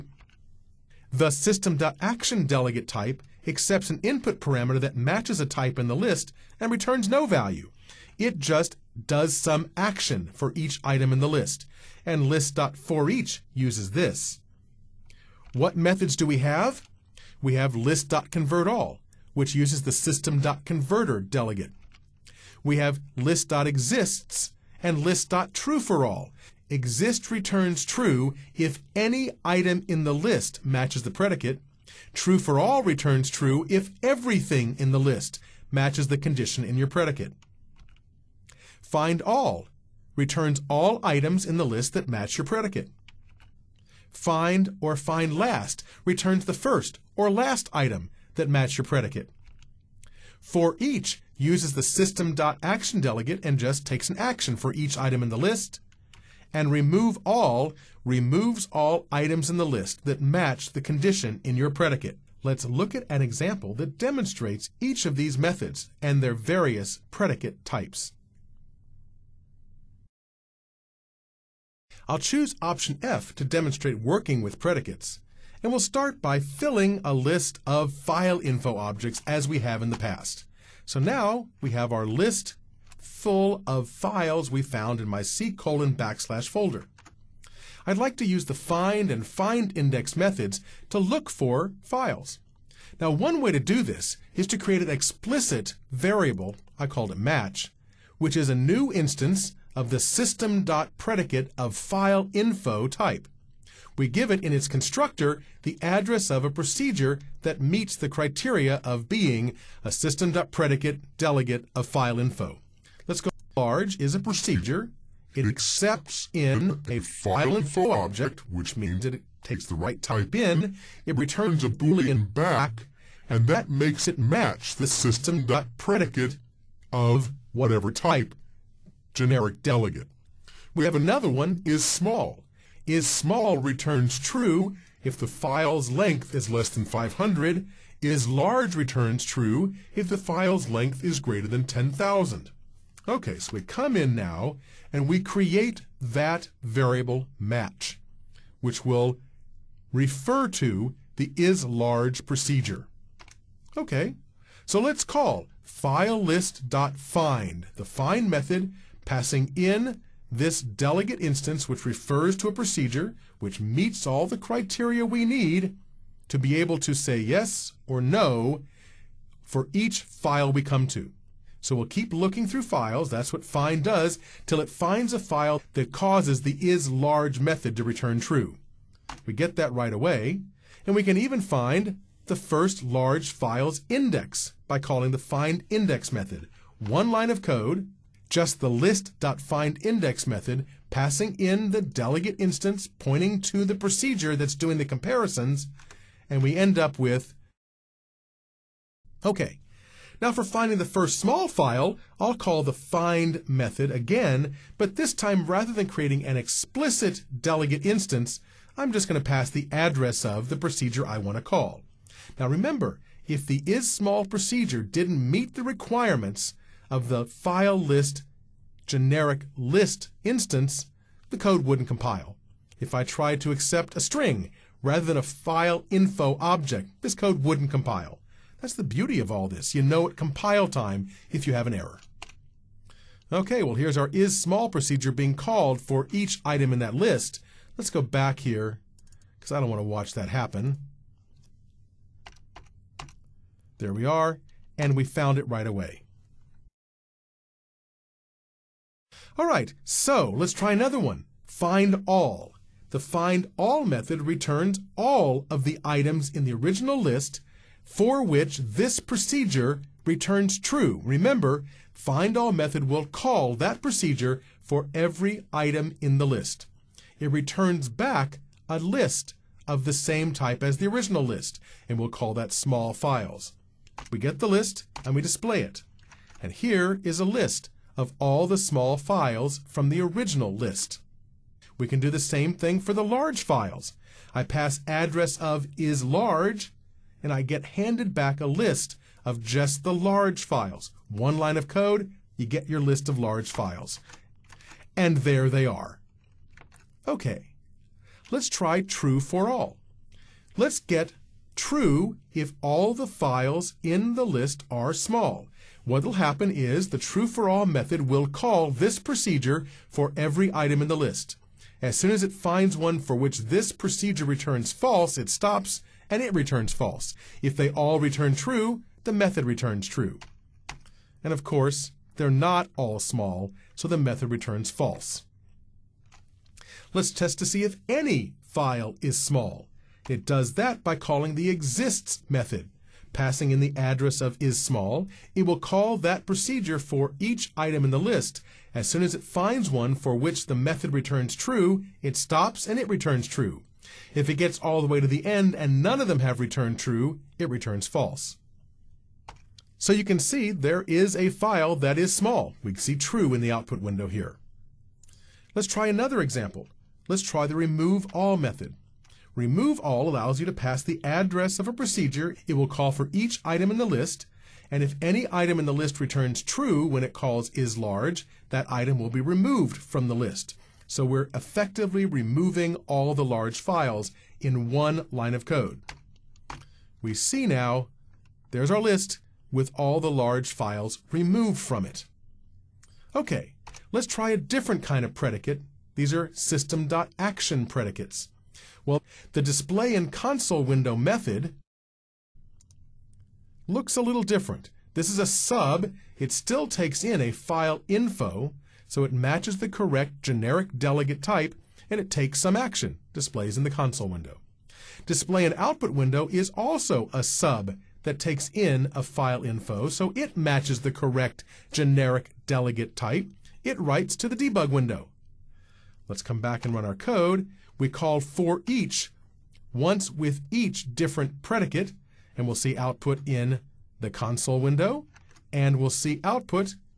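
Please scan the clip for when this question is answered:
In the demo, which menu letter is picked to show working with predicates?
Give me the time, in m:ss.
1:12.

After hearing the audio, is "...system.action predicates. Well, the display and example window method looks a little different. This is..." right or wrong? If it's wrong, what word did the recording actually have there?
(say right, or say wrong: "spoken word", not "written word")
wrong: "console", not "example".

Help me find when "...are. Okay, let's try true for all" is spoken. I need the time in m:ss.
4:55.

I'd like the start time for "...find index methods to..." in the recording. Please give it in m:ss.
1:29.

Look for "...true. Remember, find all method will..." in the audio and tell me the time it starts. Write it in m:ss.
4:20.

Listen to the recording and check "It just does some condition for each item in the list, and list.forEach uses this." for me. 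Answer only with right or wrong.
wrong.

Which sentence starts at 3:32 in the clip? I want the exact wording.
Now remember, if the is small procedure didn't meet the requirements, of the file list generic list instance, the code wouldn't compile.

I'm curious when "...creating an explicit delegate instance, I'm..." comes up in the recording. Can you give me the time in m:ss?
3:25.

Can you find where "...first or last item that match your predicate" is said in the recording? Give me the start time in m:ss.
0:46.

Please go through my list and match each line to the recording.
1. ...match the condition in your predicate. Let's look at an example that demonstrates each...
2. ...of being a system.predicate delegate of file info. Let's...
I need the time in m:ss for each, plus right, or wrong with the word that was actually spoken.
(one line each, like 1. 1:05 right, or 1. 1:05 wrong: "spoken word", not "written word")
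1. 1:00 right
2. 1:48 right.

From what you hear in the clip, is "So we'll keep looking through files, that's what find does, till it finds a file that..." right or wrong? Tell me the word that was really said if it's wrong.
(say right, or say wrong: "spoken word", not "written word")
right.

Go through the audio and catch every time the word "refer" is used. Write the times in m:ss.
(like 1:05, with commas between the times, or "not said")
2:29, 2:41.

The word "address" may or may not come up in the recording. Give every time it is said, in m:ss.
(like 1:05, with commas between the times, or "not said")
1:45, 3:29, 4:44, 5:33, 6:01.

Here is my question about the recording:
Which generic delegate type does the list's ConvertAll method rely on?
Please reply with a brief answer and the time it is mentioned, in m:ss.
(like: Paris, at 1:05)
System.Converter, at 0:19.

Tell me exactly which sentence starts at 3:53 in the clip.
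Okay, well here's our is small procedure being called for each item in that list.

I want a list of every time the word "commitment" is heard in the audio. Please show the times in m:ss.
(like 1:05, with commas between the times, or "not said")
not said.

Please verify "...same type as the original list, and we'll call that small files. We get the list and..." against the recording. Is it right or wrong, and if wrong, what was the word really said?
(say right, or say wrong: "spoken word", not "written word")
right.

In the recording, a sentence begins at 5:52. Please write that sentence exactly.
We see true in the output window here.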